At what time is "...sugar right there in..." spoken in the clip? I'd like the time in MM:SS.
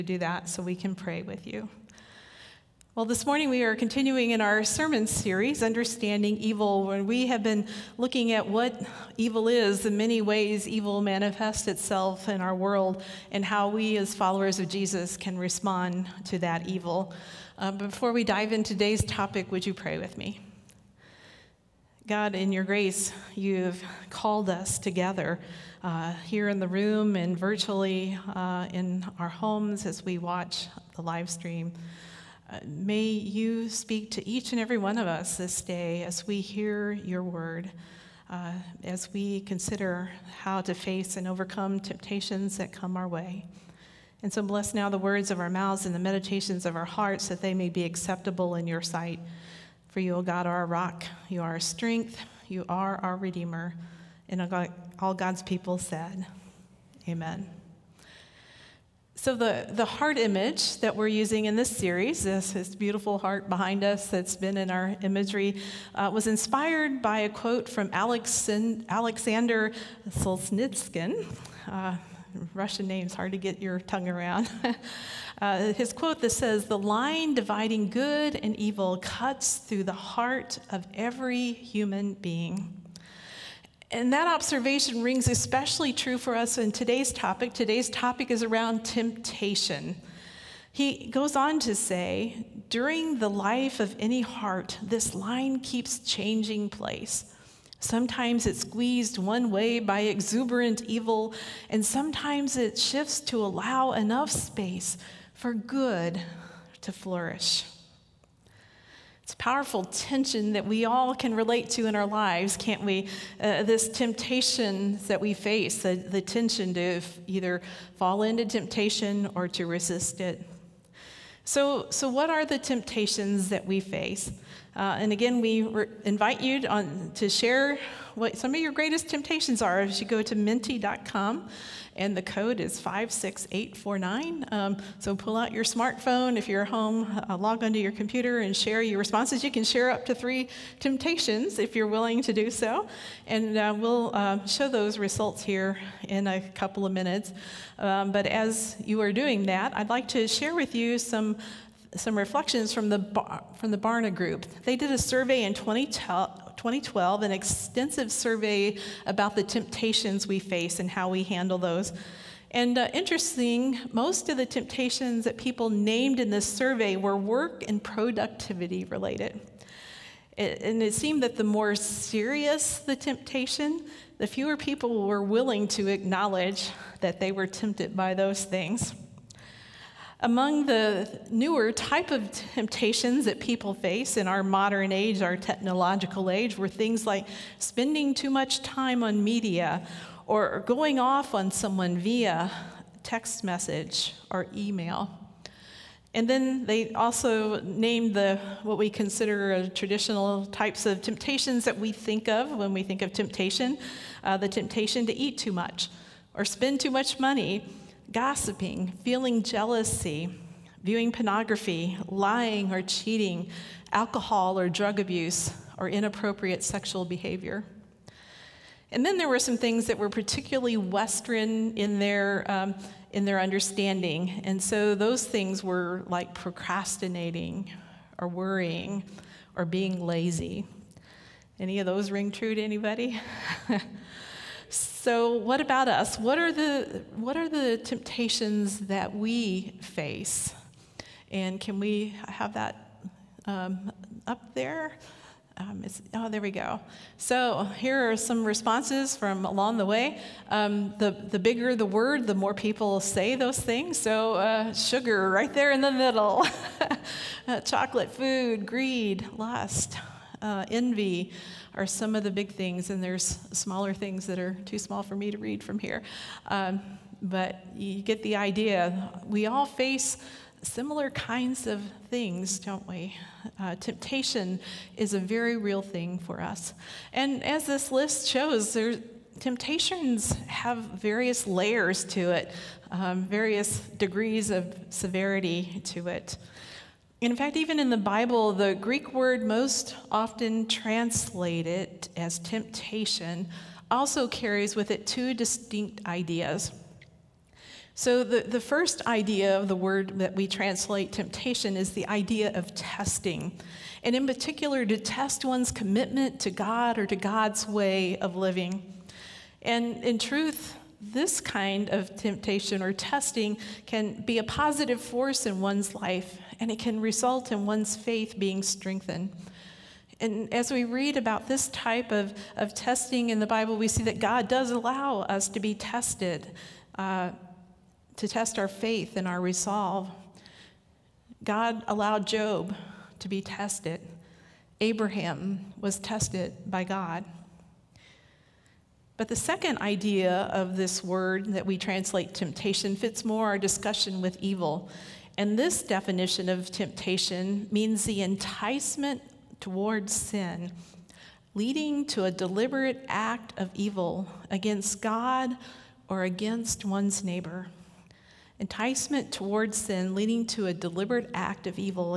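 04:14.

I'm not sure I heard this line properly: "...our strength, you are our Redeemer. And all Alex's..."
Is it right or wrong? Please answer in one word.
wrong.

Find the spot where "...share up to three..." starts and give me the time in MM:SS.
02:19.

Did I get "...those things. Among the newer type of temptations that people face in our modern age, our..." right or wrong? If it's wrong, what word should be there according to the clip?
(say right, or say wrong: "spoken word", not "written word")
right.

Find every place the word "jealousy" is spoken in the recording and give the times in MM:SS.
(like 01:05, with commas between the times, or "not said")
03:29.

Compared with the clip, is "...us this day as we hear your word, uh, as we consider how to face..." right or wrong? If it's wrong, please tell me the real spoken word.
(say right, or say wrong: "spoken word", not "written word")
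right.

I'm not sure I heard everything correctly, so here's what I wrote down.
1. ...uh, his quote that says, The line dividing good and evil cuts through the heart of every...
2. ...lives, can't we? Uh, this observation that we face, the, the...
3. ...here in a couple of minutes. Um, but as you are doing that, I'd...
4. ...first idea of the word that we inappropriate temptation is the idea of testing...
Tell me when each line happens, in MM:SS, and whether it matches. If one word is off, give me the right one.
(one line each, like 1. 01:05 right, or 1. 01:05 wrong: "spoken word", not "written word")
1. 01:15 right
2. 01:52 wrong: "temptation", not "observation"
3. 02:25 right
4. 04:58 wrong: "translate", not "inappropriate".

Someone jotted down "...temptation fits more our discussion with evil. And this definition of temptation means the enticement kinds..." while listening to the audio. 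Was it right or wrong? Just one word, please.
wrong.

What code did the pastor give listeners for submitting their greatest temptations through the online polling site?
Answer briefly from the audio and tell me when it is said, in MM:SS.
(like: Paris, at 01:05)
56849, at 02:12.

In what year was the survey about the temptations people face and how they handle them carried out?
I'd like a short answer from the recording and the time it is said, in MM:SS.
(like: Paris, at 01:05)
2012, at 02:35.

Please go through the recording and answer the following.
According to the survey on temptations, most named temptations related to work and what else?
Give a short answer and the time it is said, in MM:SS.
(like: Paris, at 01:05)
productivity, at 02:47.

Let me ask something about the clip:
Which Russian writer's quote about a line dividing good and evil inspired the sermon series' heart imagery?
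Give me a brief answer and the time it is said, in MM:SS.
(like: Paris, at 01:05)
Alexander Solzhenitsyn, at 01:08.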